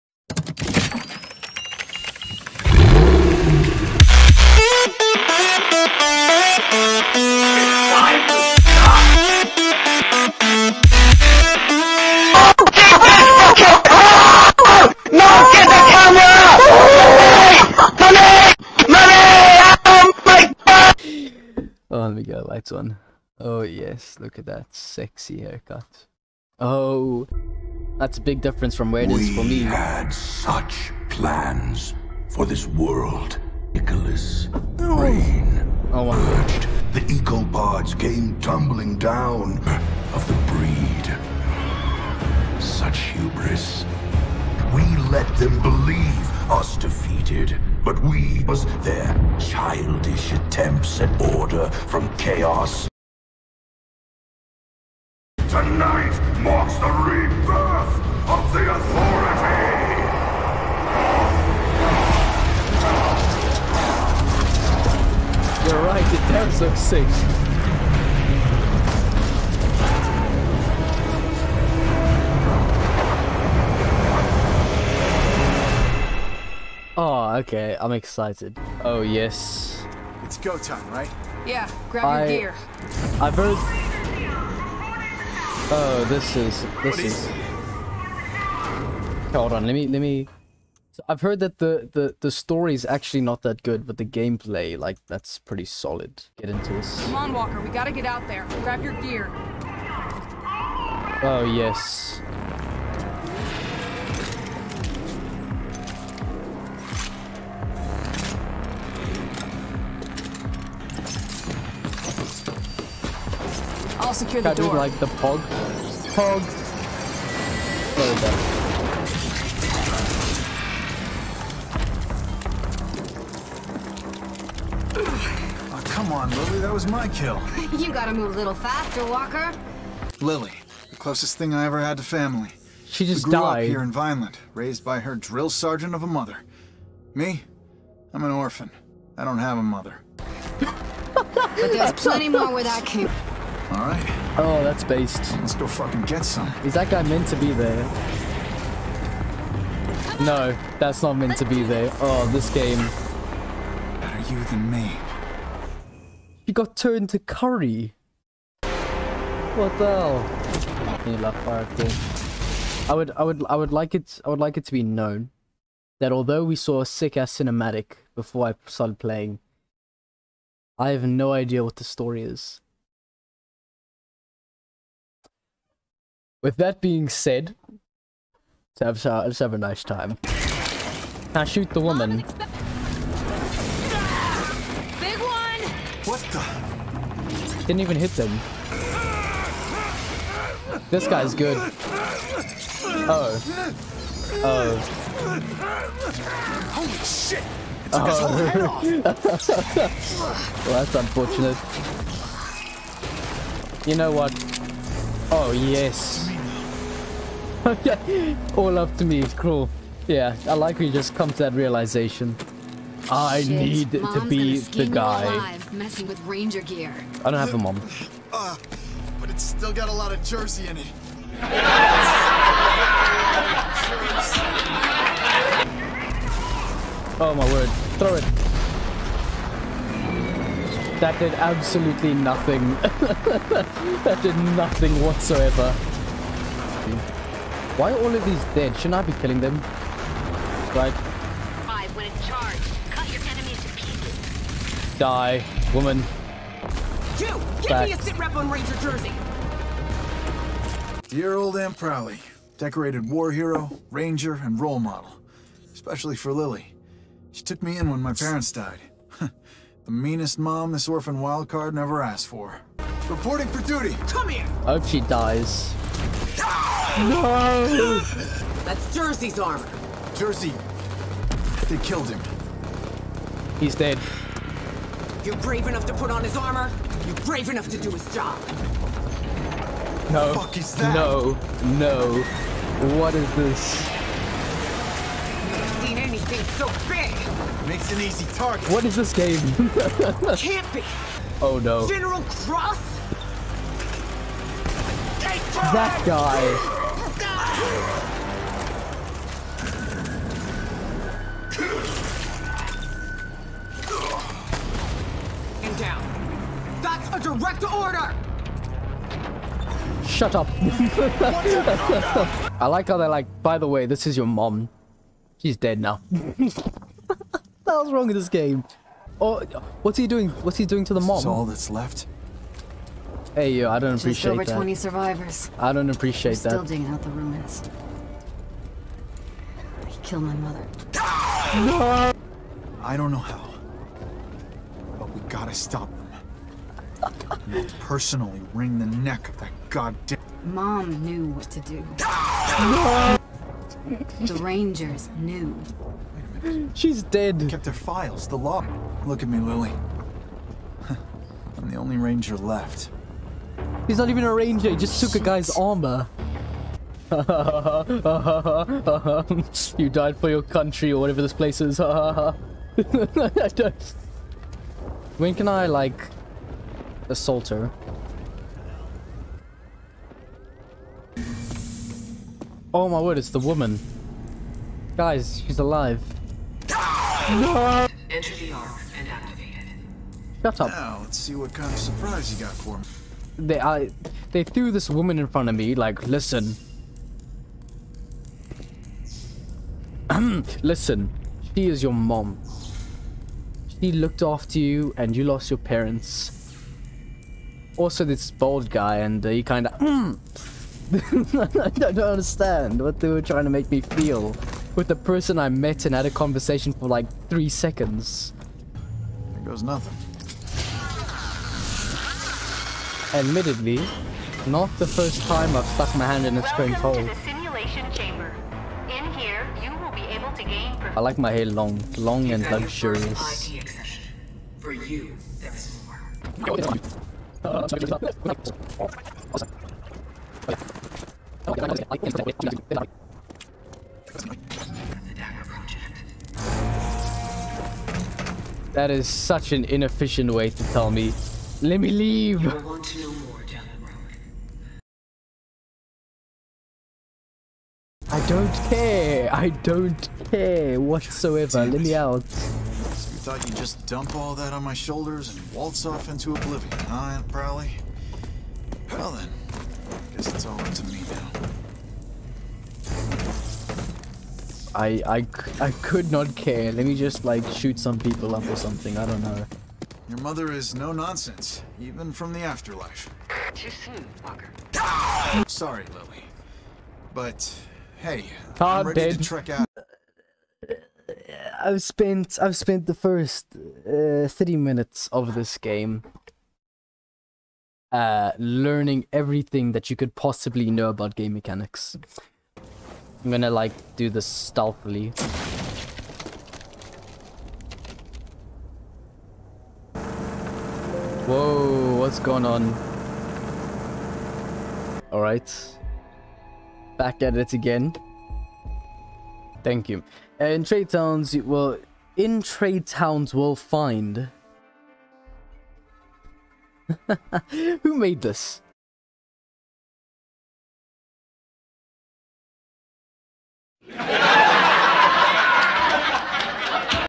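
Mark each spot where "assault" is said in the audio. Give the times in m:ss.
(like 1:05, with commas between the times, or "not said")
6:07.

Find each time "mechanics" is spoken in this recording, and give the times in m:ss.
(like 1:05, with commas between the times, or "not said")
8:11.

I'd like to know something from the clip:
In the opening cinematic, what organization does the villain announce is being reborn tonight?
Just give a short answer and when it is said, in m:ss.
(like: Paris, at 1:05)
the Authority, at 0:58.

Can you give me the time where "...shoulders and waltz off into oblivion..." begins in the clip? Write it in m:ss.
7:34.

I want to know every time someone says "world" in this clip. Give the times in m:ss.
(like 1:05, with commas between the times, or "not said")
0:32.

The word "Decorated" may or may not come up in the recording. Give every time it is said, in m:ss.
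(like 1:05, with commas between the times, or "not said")
4:12.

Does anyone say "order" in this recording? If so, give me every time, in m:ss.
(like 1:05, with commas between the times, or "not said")
0:51, 5:07.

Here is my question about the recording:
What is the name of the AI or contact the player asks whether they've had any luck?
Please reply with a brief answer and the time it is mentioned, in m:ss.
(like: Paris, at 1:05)
Oracle, at 2:41.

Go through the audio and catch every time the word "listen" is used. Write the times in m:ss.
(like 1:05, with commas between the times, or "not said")
6:26, 6:30.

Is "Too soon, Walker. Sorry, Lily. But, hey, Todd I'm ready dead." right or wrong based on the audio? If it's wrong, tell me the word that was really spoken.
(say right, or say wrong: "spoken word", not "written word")
right.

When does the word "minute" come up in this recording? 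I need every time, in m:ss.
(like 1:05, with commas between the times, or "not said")
5:46, 8:04.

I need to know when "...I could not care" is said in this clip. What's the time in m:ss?
7:45.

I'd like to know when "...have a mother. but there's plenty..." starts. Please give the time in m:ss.
2:19.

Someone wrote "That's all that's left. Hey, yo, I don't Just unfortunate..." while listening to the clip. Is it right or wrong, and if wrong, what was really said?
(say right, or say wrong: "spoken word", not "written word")
wrong: "appreciate", not "unfortunate".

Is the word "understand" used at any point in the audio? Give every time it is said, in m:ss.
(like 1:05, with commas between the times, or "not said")
6:41.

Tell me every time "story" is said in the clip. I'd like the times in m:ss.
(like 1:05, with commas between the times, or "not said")
1:32, 2:51.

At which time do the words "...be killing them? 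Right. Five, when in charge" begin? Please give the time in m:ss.
3:59.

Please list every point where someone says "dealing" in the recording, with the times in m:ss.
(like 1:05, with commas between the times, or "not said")
not said.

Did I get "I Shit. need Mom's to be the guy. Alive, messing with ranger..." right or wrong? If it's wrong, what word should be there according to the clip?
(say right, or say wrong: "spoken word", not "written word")
right.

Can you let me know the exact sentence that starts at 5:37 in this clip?
And I'll personally wring the neck of that goddamn.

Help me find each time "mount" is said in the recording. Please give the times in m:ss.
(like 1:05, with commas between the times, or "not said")
not said.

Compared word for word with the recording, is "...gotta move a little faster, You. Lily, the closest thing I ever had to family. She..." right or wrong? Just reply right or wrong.
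wrong.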